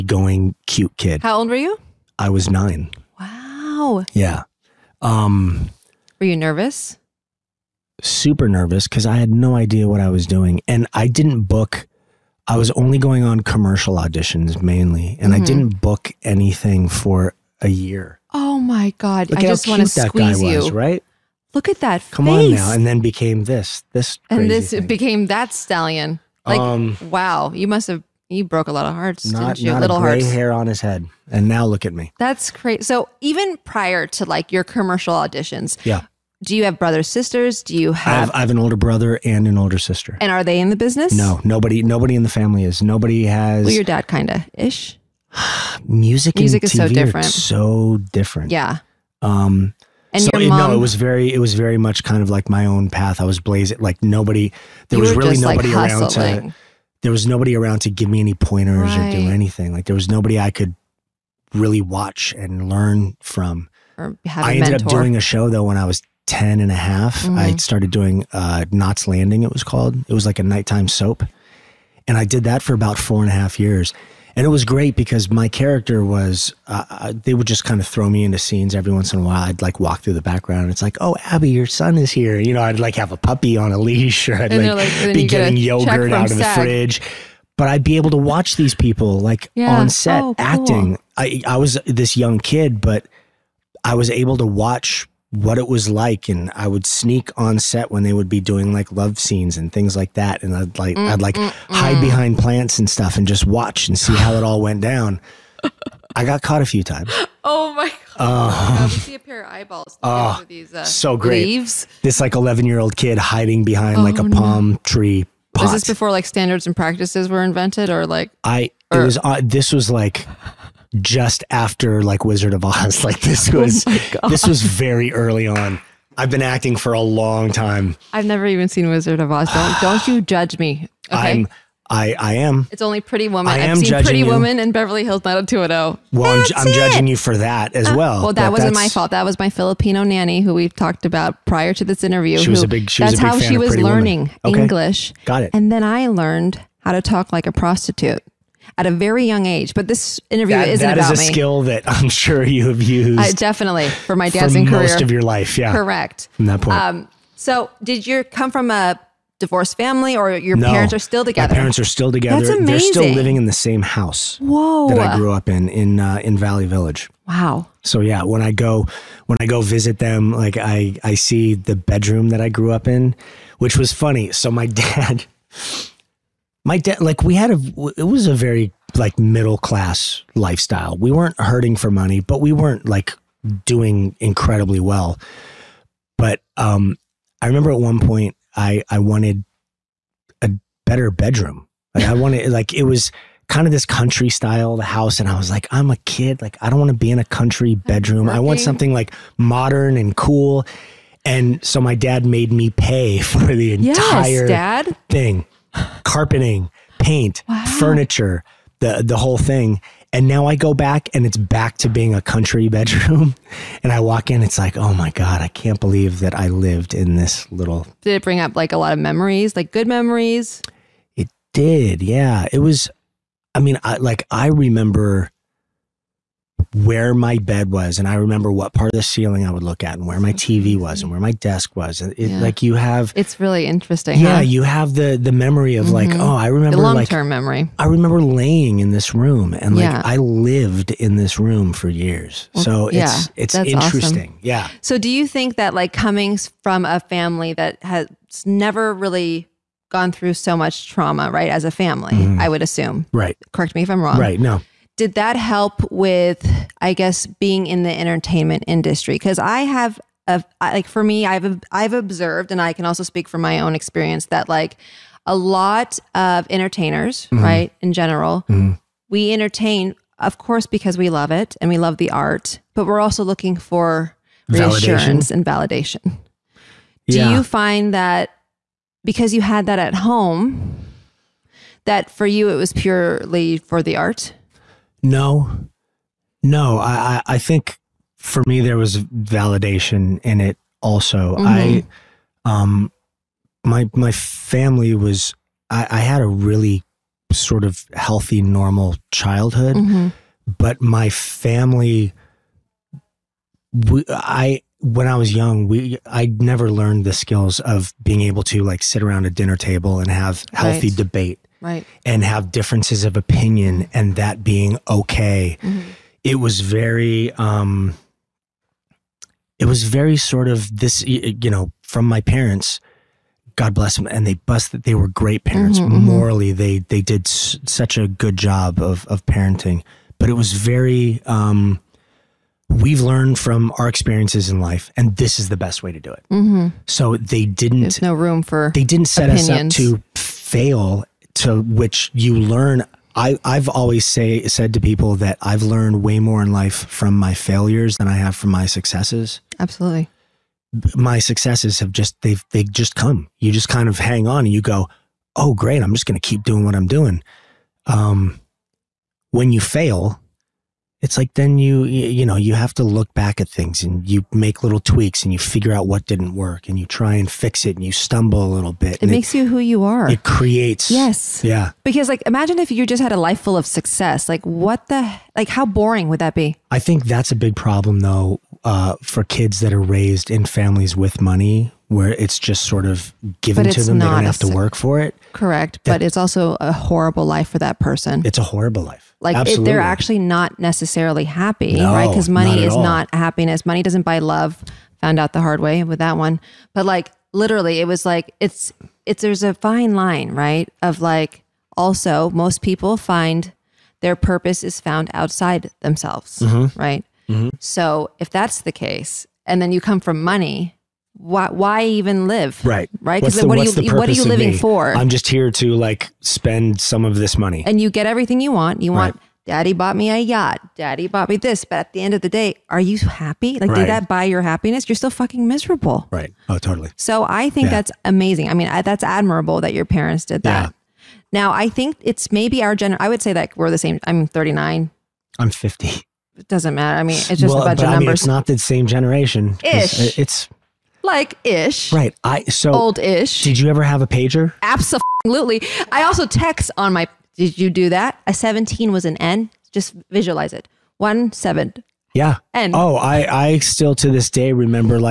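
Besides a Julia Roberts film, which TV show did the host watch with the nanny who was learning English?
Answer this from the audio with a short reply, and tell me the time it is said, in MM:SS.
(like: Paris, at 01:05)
Beverly Hills 90210, at 02:14.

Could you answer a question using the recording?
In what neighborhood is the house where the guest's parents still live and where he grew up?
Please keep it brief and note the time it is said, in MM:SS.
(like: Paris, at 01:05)
Valley Village, at 02:46.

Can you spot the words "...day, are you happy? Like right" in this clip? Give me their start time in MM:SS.
07:02.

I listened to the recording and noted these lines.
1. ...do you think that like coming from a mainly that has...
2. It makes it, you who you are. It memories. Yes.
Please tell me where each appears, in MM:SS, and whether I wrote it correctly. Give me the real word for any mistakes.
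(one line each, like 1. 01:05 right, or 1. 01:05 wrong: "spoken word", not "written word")
1. 04:04 wrong: "family", not "mainly"
2. 06:09 wrong: "creates", not "memories".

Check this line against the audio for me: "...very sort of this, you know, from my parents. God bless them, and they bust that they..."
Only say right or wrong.
right.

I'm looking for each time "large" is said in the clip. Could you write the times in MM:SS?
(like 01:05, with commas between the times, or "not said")
not said.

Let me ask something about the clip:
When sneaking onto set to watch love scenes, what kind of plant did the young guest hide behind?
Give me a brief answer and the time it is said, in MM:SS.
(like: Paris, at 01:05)
palm tree, at 01:54.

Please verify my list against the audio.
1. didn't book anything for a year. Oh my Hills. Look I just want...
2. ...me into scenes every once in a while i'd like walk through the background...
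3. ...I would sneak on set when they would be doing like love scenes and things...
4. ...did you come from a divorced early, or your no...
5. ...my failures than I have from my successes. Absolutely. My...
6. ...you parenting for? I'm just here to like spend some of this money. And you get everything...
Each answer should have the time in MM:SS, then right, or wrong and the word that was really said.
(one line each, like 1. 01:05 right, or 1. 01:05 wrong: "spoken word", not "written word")
1. 00:15 wrong: "God", not "Hills"
2. 01:18 right
3. 01:36 right
4. 02:37 wrong: "family", not "early"
5. 05:47 right
6. 06:54 wrong: "living", not "parenting".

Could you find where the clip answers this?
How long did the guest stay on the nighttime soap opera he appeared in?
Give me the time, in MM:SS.
01:12.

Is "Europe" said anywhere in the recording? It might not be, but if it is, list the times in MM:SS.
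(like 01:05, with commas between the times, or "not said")
not said.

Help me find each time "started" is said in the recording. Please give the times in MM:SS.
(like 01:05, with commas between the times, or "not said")
01:07.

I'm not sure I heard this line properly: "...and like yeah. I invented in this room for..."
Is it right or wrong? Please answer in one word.
wrong.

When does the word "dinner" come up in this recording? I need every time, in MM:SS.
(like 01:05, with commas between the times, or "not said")
05:09.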